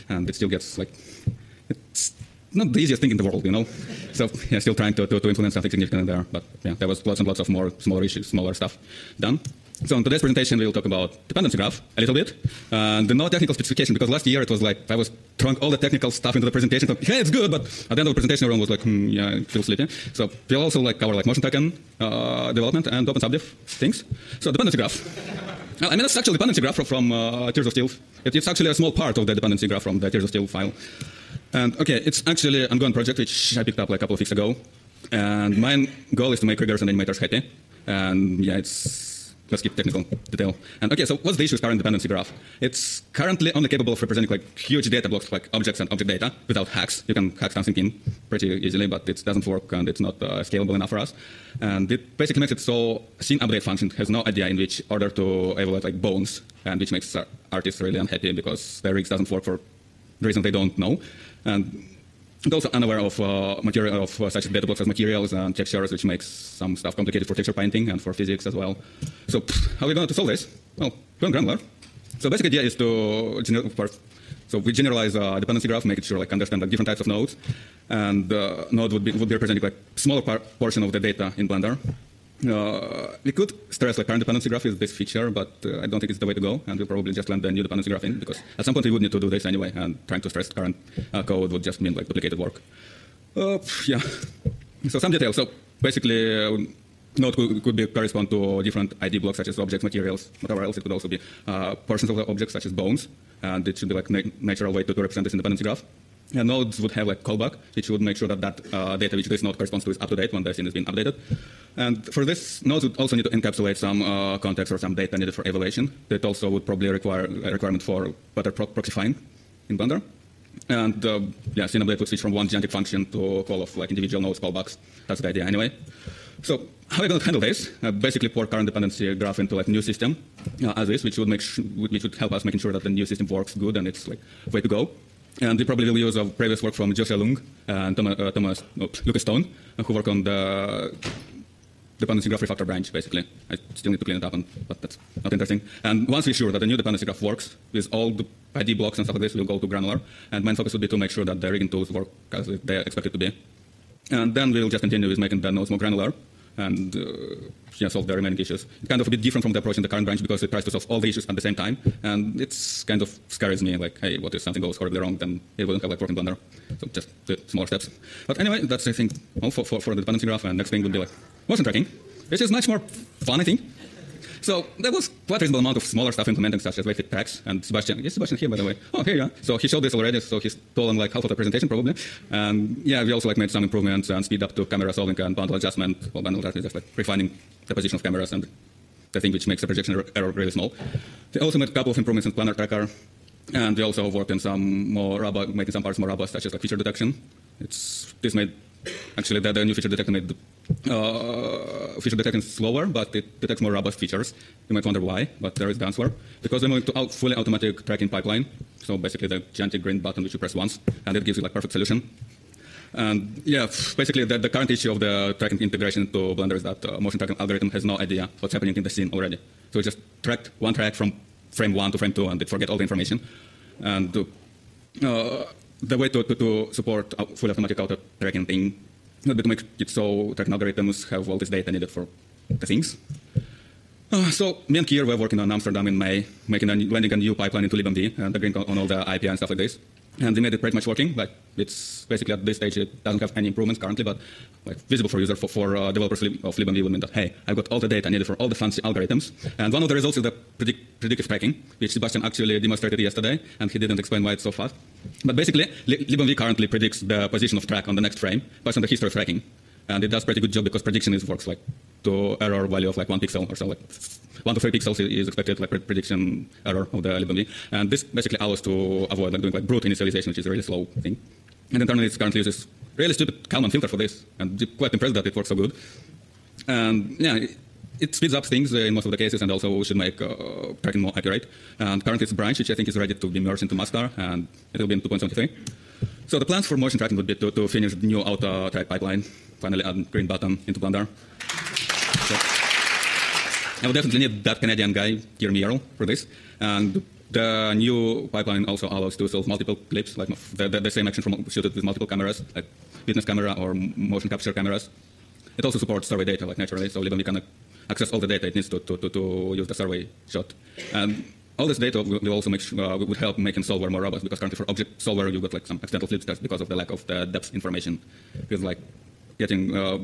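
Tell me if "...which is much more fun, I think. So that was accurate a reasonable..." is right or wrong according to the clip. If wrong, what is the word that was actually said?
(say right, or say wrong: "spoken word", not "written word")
wrong: "quite", not "accurate".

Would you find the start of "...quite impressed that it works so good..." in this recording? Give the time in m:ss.
4:34.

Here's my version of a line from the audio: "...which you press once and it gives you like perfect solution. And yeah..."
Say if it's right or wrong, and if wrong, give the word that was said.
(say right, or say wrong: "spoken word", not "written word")
right.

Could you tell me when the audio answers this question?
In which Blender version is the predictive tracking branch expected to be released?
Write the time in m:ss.
4:45.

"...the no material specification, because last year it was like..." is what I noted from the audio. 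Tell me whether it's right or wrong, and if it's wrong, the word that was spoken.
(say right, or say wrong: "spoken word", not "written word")
wrong: "technical", not "material".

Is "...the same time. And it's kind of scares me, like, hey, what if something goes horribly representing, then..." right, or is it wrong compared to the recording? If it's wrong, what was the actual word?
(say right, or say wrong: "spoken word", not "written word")
wrong: "wrong", not "representing".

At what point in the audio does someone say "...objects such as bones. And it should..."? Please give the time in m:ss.
1:42.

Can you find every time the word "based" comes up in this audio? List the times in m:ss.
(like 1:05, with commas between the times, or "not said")
4:18.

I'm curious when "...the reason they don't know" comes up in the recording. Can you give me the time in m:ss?
1:00.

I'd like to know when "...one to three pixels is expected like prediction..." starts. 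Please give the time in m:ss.
4:24.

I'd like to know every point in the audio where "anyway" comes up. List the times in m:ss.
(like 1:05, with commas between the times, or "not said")
1:29, 2:05, 2:48.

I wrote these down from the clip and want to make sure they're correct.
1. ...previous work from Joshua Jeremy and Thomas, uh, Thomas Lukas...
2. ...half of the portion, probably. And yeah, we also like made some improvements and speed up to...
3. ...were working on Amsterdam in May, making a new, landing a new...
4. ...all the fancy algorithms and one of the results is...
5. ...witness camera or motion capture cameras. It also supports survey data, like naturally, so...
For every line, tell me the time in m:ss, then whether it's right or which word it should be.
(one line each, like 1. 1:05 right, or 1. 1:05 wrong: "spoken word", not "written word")
1. 2:16 wrong: "Leung", not "Jeremy"
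2. 3:01 wrong: "presentation", not "portion"
3. 3:55 right
4. 4:08 right
5. 5:03 right.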